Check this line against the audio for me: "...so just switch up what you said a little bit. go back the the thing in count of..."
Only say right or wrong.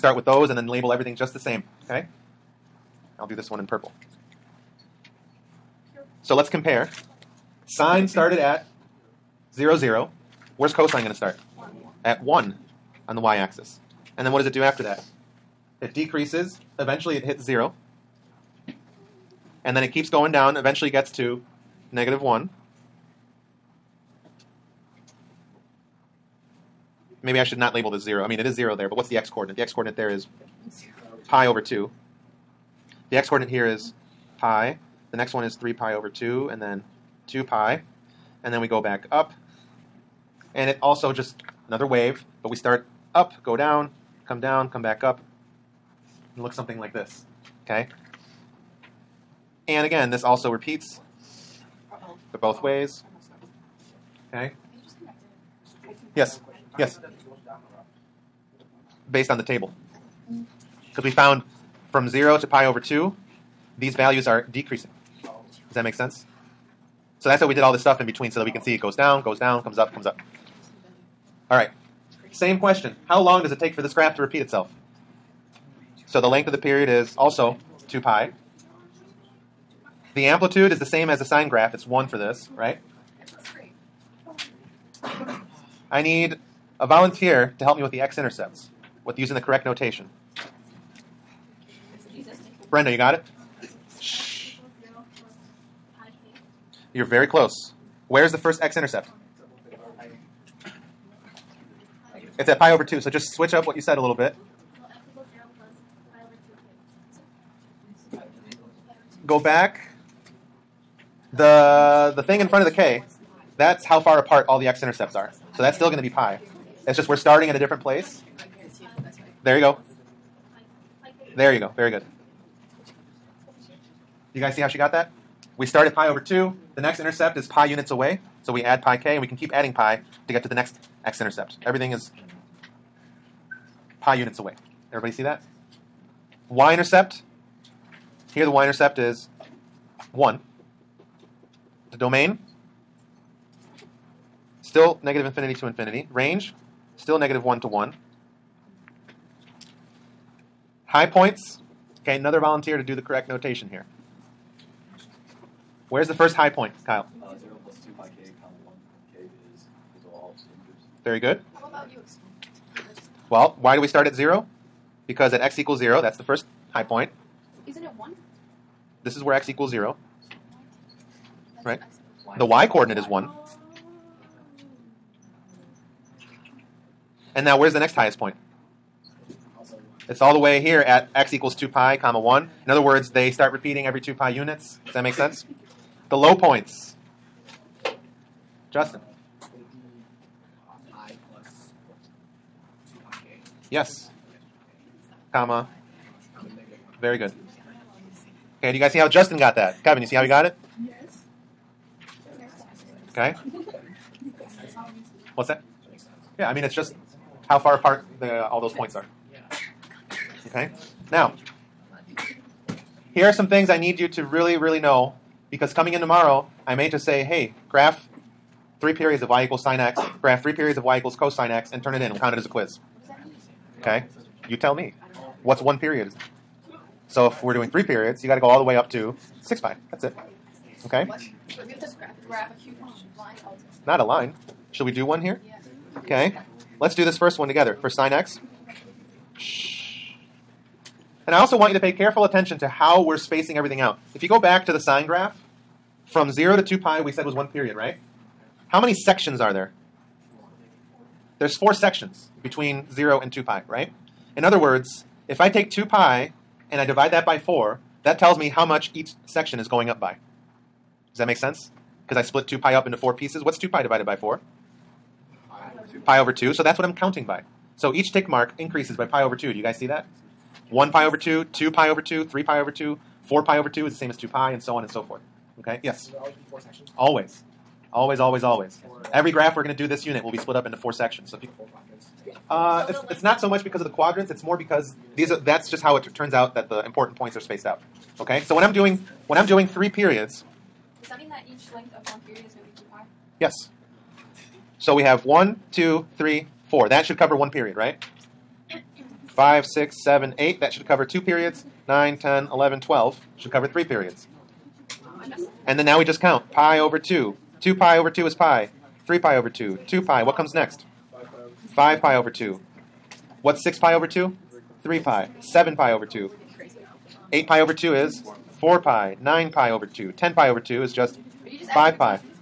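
wrong.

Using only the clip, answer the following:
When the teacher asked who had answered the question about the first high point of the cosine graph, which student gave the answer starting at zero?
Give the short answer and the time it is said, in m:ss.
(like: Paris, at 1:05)
Kyle, at 2:36.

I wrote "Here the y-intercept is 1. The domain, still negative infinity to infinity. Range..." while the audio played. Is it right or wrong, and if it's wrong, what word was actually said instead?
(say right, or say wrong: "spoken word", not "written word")
right.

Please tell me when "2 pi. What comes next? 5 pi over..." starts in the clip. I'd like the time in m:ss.
5:09.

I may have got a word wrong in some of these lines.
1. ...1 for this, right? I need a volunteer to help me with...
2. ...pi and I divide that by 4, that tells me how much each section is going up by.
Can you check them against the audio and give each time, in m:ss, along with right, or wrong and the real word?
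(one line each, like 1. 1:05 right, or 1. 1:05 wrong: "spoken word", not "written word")
1. 1:21 right
2. 4:15 right.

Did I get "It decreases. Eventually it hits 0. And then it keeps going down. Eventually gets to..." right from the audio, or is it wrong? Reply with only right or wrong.
right.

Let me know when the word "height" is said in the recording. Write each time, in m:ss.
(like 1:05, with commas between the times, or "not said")
not said.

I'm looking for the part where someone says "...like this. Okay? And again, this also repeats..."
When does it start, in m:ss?
0:46.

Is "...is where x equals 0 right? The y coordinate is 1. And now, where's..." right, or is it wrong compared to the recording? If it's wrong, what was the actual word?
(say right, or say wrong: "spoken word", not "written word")
right.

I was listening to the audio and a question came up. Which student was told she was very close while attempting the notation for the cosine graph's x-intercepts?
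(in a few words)
Brenda.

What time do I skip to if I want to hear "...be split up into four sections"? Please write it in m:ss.
4:40.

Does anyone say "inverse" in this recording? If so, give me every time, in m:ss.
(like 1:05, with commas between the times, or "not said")
not said.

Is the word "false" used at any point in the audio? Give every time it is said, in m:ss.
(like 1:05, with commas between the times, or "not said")
not said.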